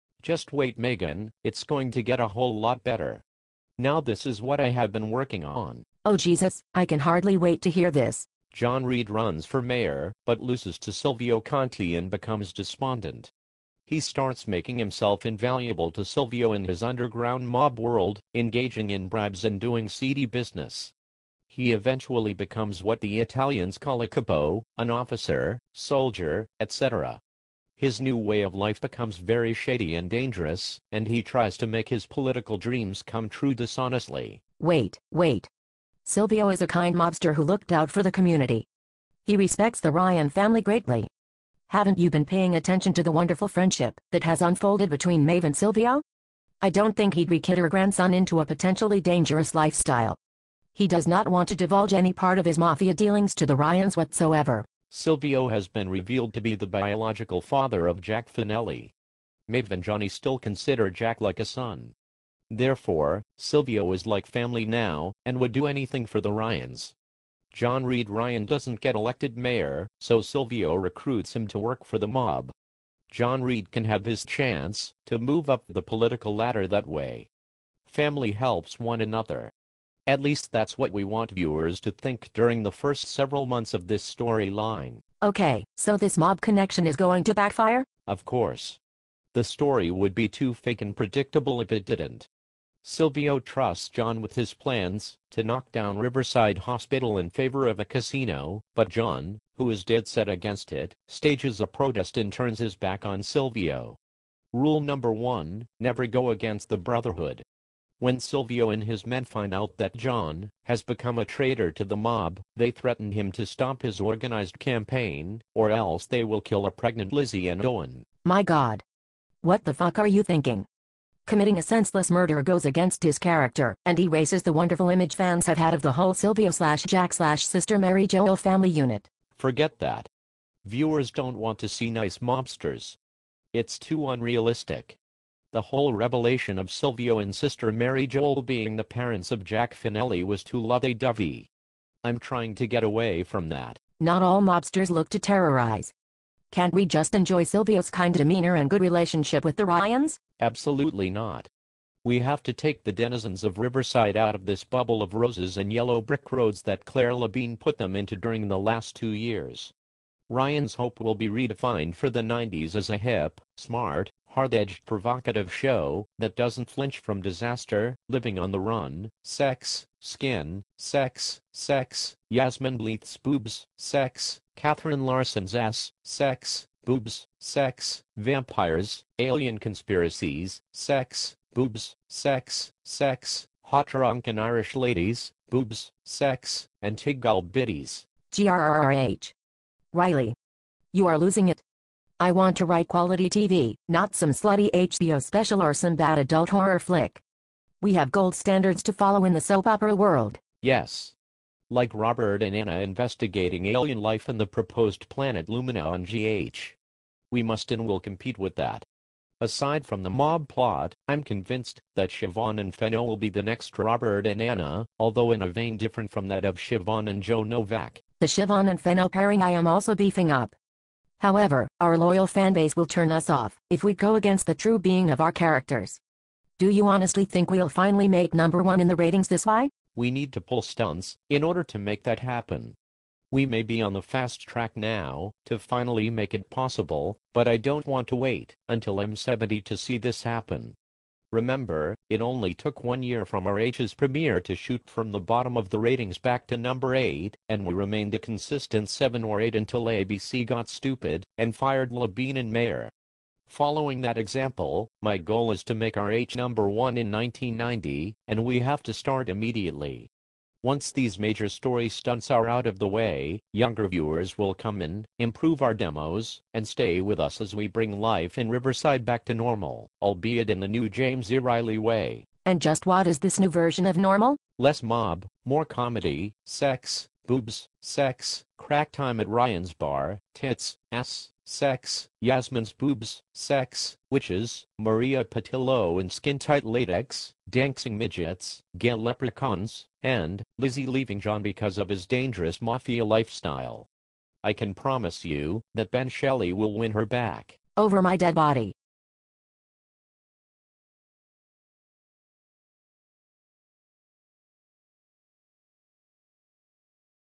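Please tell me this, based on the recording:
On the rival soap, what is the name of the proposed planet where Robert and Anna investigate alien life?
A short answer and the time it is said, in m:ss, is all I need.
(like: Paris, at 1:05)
Lumina, at 3:25.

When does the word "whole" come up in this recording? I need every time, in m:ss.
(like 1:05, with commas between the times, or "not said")
0:02, 2:05, 2:15.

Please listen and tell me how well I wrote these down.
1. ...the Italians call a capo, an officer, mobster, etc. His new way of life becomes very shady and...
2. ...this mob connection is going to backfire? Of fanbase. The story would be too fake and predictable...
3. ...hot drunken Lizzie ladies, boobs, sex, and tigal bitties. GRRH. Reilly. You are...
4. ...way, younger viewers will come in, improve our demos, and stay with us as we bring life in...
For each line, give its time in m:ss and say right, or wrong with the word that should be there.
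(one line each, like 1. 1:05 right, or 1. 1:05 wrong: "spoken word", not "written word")
1. 0:23 wrong: "soldier", not "mobster"
2. 1:25 wrong: "course", not "fanbase"
3. 3:03 wrong: "Irish", not "Lizzie"
4. 4:22 right.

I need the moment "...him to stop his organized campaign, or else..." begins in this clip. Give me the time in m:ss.
1:53.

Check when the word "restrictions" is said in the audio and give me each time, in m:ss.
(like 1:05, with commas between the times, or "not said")
not said.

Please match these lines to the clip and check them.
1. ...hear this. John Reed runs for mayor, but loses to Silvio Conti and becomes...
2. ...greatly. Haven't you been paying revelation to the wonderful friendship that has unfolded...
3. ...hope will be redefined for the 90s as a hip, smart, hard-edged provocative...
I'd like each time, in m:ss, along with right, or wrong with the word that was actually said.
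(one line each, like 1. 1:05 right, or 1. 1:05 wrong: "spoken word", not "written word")
1. 0:07 right
2. 0:40 wrong: "attention", not "revelation"
3. 2:40 right.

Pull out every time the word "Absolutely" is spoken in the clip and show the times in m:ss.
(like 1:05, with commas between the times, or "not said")
2:30.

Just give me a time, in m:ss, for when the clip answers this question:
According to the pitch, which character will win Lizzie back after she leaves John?
4:55.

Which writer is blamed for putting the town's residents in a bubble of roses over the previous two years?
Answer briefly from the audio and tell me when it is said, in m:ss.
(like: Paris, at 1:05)
Claire Labine, at 2:36.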